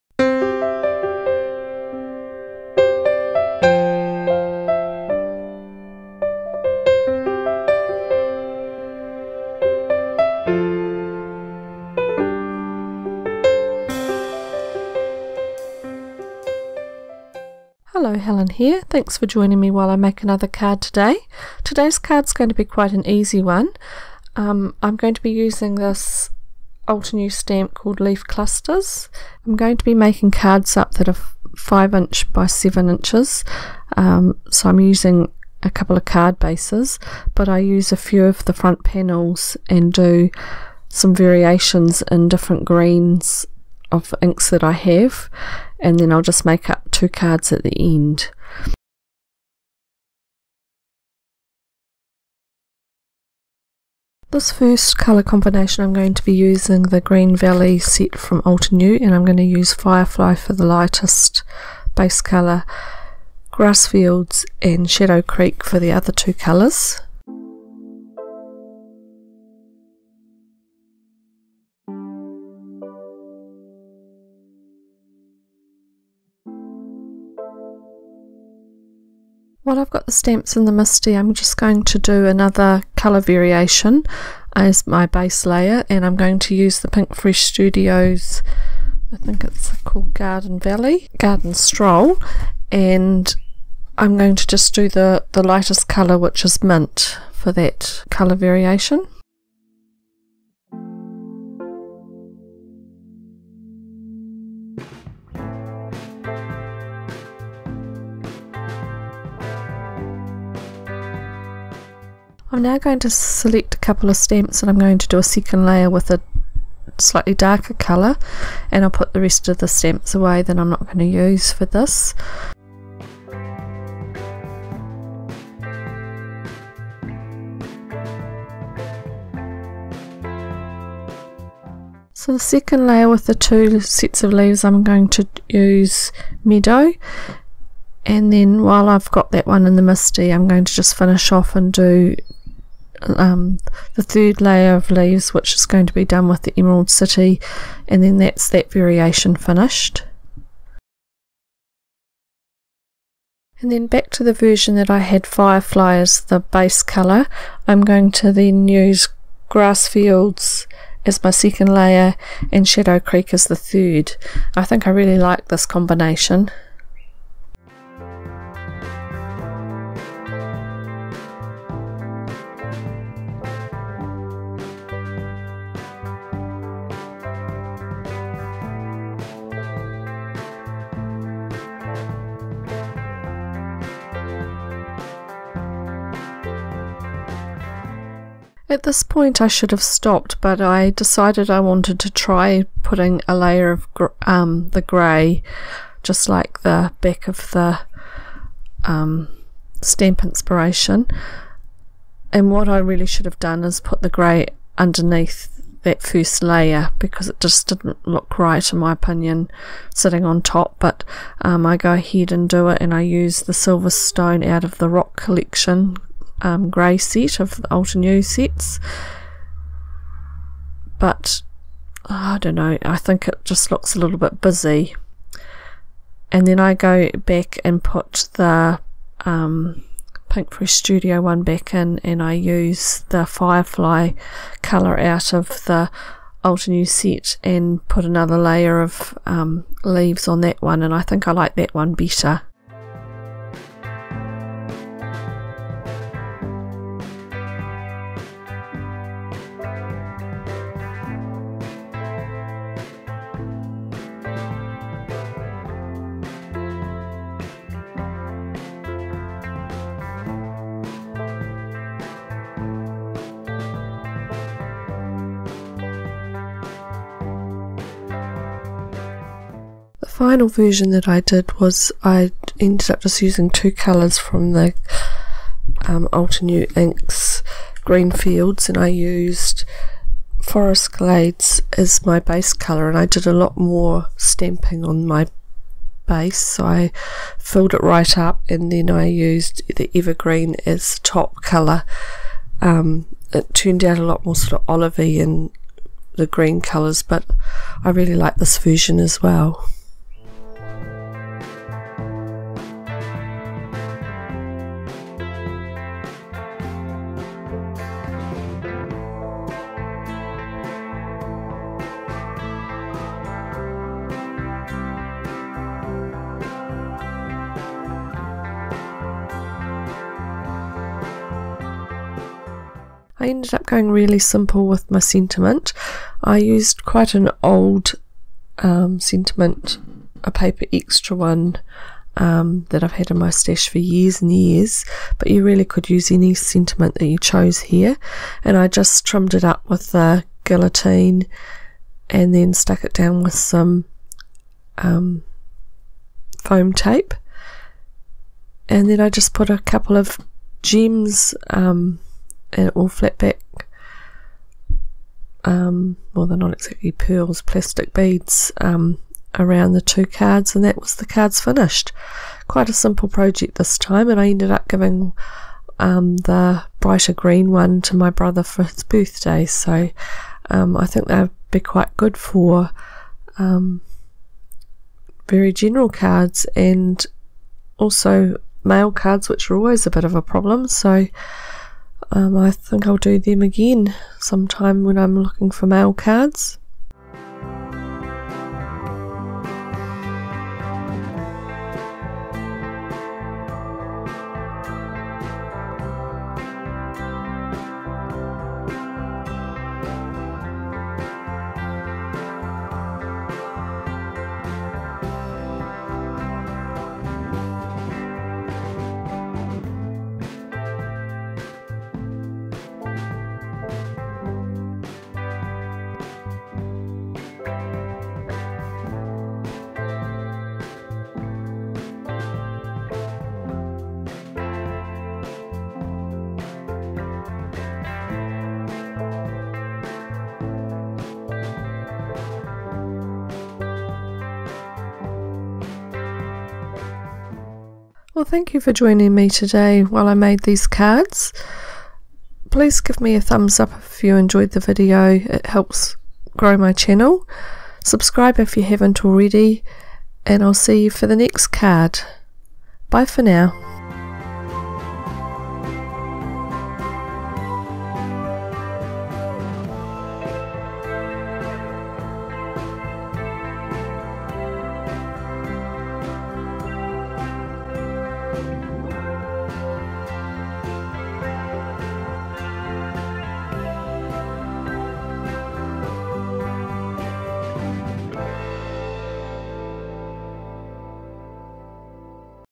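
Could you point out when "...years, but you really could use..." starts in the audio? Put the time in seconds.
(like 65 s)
334 s.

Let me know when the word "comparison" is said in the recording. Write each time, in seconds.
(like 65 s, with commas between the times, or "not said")
not said.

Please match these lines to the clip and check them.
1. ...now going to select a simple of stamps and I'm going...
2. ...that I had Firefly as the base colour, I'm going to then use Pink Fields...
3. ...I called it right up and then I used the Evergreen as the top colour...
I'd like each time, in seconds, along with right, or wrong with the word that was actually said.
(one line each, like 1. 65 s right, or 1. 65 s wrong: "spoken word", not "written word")
1. 112 s wrong: "couple", not "simple"
2. 154 s wrong: "Grass", not "Pink"
3. 286 s wrong: "filled", not "called".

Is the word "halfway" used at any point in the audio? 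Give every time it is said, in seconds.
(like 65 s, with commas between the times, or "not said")
not said.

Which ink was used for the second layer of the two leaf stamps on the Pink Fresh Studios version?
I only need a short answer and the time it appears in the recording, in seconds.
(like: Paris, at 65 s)
Meadow, at 136 s.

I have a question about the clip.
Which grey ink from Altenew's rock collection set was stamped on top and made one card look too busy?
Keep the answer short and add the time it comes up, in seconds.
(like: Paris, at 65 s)
Silver Stone, at 213 s.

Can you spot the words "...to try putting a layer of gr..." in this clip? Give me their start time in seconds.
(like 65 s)
191 s.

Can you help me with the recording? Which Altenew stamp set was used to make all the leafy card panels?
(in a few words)
Leaf Clusters.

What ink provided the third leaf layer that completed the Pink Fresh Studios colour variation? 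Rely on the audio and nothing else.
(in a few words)
Emerald City.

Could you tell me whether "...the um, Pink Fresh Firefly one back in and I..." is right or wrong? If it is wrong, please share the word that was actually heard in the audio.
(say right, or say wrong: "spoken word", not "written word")
wrong: "Studio", not "Firefly".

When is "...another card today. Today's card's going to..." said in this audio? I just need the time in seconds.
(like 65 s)
20 s.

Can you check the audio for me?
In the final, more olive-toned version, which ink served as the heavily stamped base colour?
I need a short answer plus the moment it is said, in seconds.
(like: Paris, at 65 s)
Forest Glades, at 280 s.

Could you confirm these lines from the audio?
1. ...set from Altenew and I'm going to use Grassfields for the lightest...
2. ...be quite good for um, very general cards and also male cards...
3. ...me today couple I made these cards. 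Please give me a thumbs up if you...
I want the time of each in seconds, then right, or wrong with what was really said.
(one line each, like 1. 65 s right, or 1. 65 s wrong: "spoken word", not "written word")
1. 57 s wrong: "Firefly", not "Grassfields"
2. 371 s right
3. 439 s wrong: "while", not "couple".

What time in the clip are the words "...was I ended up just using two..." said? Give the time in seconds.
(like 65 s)
271 s.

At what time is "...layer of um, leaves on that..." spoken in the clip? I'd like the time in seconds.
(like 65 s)
238 s.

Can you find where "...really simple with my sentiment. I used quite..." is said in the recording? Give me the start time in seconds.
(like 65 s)
323 s.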